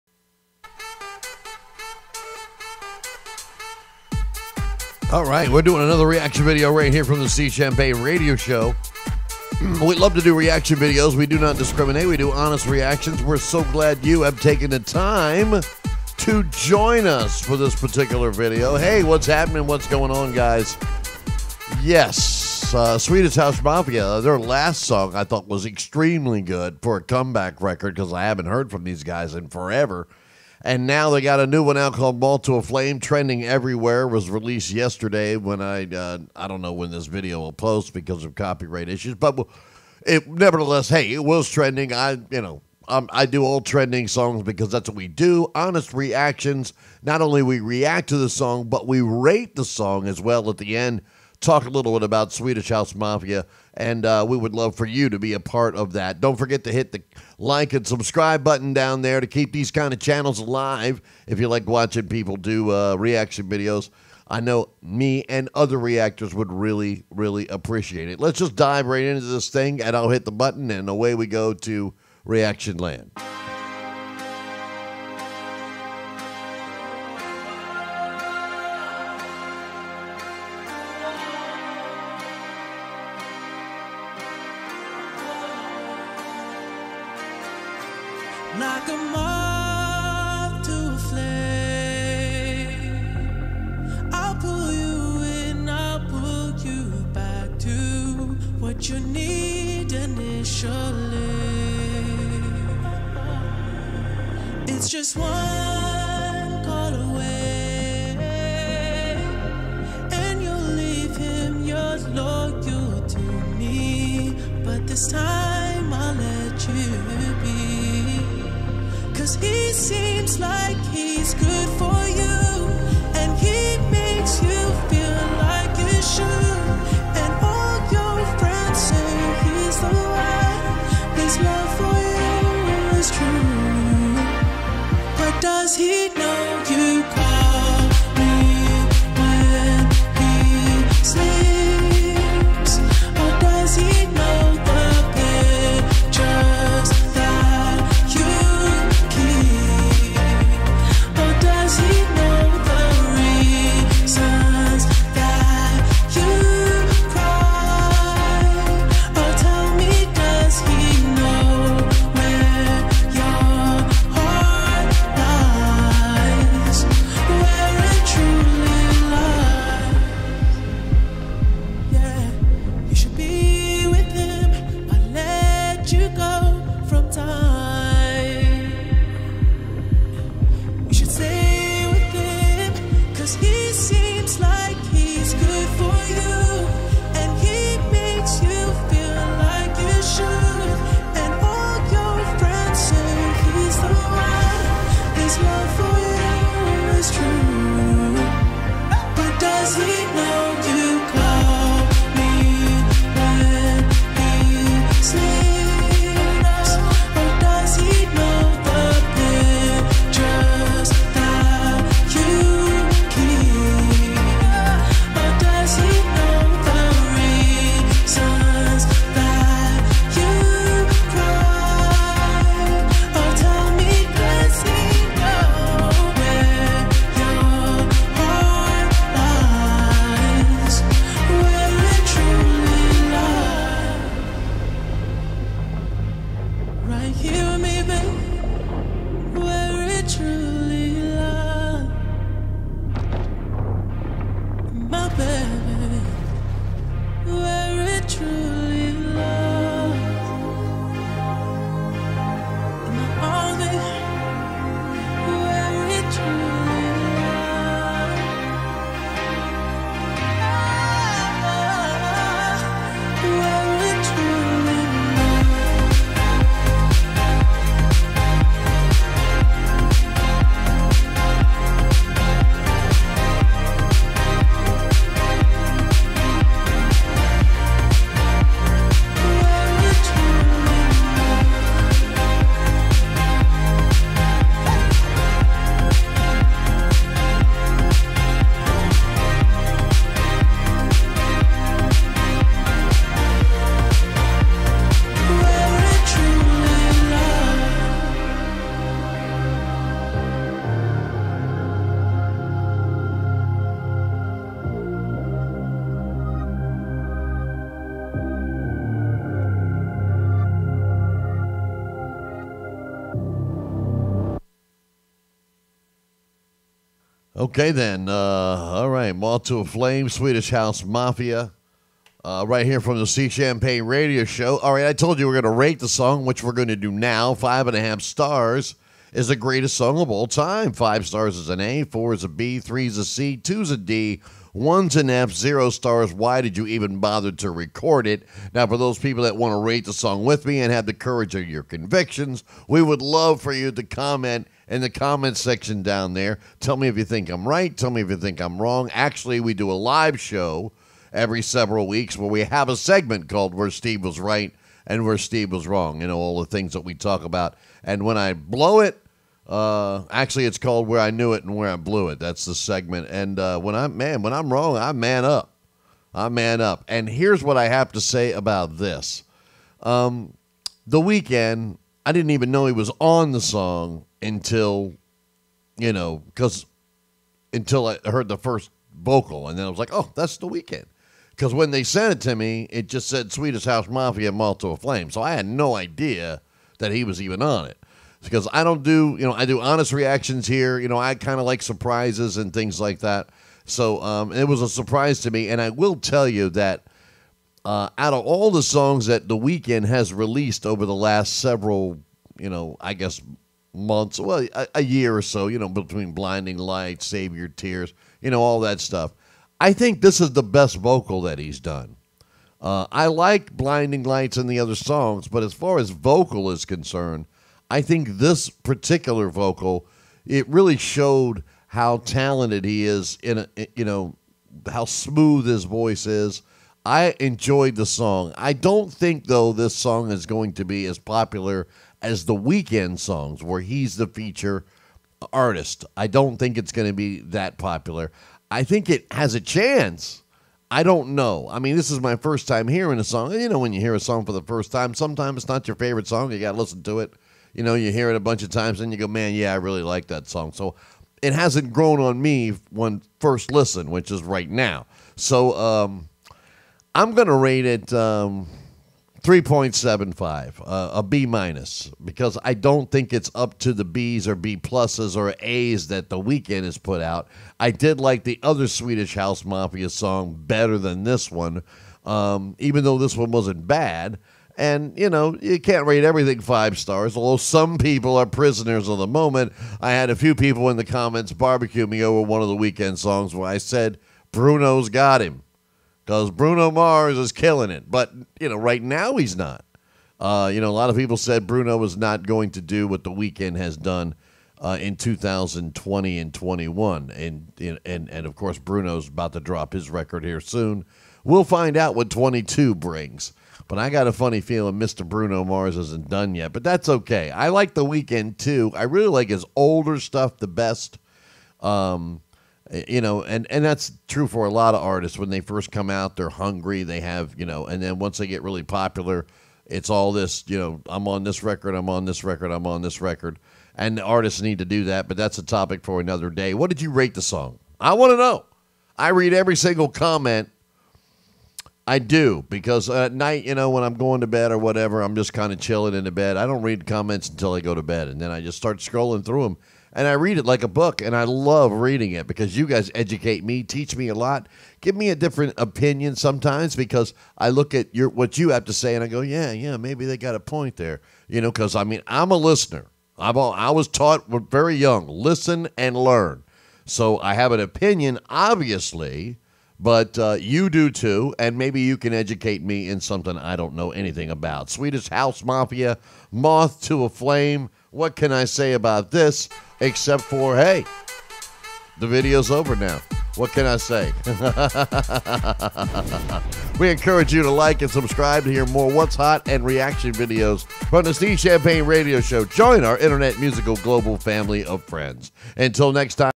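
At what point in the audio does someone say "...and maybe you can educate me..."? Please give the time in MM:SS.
09:21.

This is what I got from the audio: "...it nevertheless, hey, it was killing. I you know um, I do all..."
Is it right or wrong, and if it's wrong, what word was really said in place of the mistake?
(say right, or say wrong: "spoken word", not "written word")
wrong: "trending", not "killing".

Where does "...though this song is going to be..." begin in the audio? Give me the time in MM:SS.
07:09.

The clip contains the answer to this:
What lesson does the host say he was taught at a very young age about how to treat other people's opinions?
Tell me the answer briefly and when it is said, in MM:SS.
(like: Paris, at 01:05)
listen and learn, at 09:15.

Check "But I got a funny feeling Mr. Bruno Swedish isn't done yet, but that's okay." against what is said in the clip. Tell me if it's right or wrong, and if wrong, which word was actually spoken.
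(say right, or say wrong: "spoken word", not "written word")
wrong: "Mars", not "Swedish".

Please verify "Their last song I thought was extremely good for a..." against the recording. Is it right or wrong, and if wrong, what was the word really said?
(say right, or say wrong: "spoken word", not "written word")
right.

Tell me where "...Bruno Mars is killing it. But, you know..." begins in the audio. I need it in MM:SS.
08:06.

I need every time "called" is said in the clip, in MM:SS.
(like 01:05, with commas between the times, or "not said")
00:31, 05:53, 06:00.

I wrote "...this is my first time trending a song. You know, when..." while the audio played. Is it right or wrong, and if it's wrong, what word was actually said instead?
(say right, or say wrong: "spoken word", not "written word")
wrong: "hearing", not "trending".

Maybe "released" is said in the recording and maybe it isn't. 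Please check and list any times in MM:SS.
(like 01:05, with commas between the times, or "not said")
00:34, 06:40.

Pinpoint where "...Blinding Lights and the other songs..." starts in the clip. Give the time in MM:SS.
06:53.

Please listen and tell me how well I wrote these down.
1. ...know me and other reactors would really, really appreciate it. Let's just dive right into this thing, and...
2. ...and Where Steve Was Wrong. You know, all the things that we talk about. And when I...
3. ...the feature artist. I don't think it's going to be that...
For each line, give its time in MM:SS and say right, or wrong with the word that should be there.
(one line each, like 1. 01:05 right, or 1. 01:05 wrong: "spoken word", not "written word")
1. 01:04 right
2. 05:54 right
3. 07:13 right.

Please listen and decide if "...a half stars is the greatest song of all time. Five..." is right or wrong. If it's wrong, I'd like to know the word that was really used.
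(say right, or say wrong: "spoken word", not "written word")
right.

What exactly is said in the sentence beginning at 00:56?
Don't forget to hit the like and subscribe button down there to keep these kind of channels alive.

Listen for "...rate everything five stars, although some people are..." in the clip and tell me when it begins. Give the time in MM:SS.
07:55.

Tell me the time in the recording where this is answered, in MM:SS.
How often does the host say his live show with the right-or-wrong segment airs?
05:51.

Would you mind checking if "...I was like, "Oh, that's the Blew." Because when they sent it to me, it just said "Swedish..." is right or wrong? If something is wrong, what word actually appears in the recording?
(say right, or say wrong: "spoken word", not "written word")
wrong: "Weeknd", not "Blew".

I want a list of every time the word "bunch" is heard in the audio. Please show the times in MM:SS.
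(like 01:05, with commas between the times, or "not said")
07:28.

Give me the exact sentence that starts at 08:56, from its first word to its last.
I don't read comments until I go to bed, and then I just start scrolling through them.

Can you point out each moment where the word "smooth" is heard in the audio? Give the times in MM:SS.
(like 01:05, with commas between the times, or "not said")
07:04.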